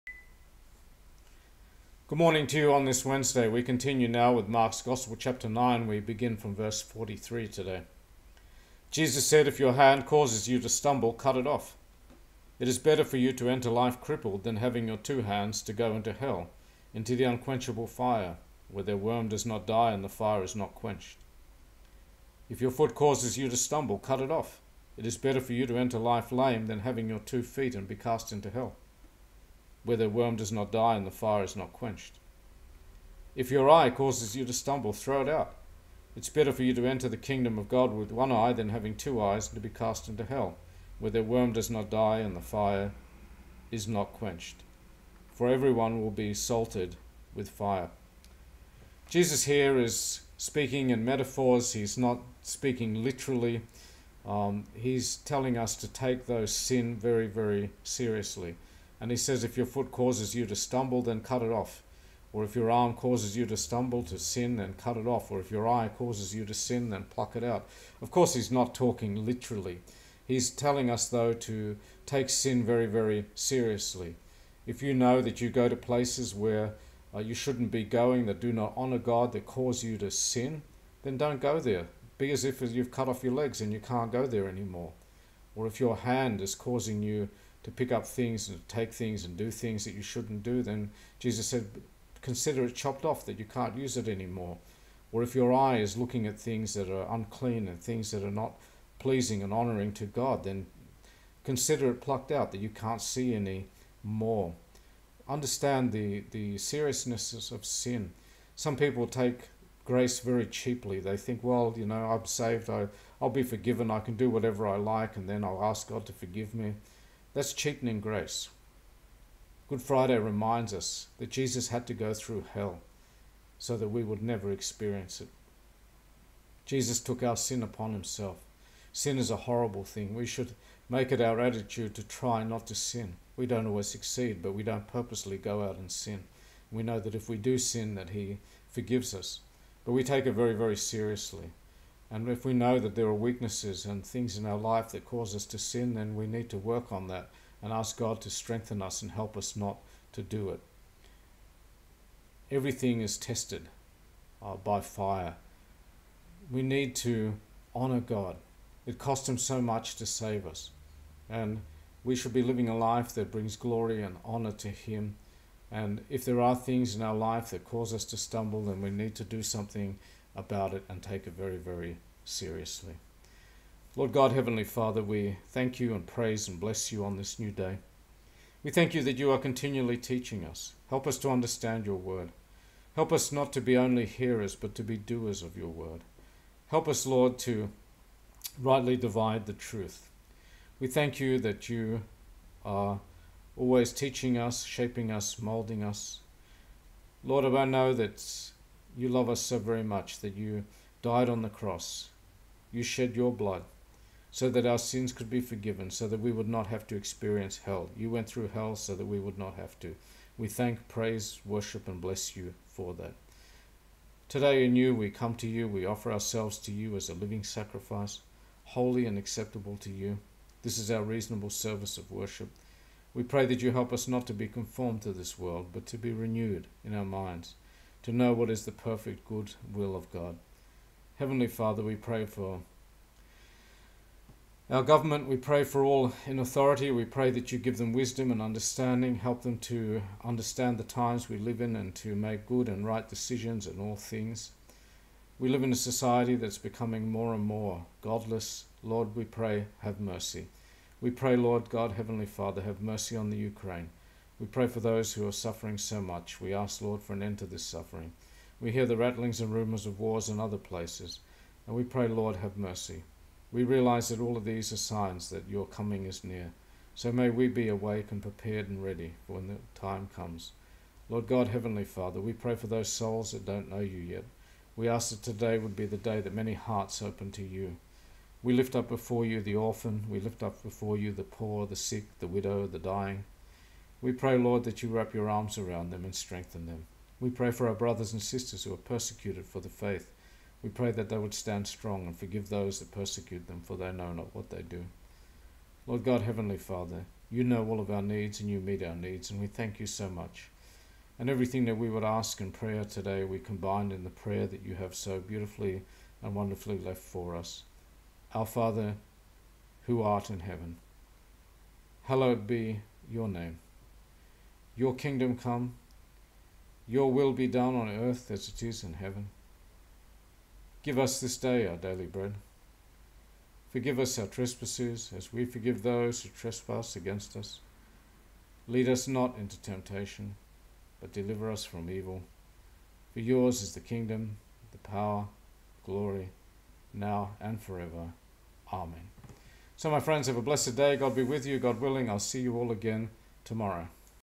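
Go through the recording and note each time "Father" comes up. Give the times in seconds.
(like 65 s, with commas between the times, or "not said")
174 s, 231 s, 252 s, 271 s, 296 s, 308 s.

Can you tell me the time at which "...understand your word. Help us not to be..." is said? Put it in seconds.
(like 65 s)
181 s.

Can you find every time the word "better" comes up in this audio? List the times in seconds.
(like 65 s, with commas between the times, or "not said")
12 s, 25 s, 36 s.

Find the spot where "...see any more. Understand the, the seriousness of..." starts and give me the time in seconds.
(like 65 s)
103 s.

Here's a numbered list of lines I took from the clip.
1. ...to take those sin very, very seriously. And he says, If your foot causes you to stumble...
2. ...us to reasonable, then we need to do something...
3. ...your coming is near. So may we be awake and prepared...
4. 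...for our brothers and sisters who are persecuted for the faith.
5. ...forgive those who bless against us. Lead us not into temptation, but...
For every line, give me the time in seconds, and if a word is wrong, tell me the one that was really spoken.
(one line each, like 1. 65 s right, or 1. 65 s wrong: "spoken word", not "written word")
1. 55 s right
2. 167 s wrong: "stumble", not "reasonable"
3. 265 s right
4. 287 s right
5. 325 s wrong: "trespass", not "bless".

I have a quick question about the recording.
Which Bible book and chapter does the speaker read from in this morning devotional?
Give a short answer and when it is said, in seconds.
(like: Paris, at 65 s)
Mark 9, at 4 s.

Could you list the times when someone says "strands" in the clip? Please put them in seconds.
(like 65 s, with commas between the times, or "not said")
not said.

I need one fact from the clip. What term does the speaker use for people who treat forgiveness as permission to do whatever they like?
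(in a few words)
cheapening grace.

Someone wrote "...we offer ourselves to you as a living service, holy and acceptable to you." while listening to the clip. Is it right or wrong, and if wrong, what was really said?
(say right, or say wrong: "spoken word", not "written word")
wrong: "sacrifice", not "service".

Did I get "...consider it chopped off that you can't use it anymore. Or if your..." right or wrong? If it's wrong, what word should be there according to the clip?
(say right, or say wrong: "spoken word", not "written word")
right.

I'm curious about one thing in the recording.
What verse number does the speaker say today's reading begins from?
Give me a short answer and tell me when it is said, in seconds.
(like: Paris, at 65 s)
43, at 6 s.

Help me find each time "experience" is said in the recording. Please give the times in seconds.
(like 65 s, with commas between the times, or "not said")
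124 s, 206 s.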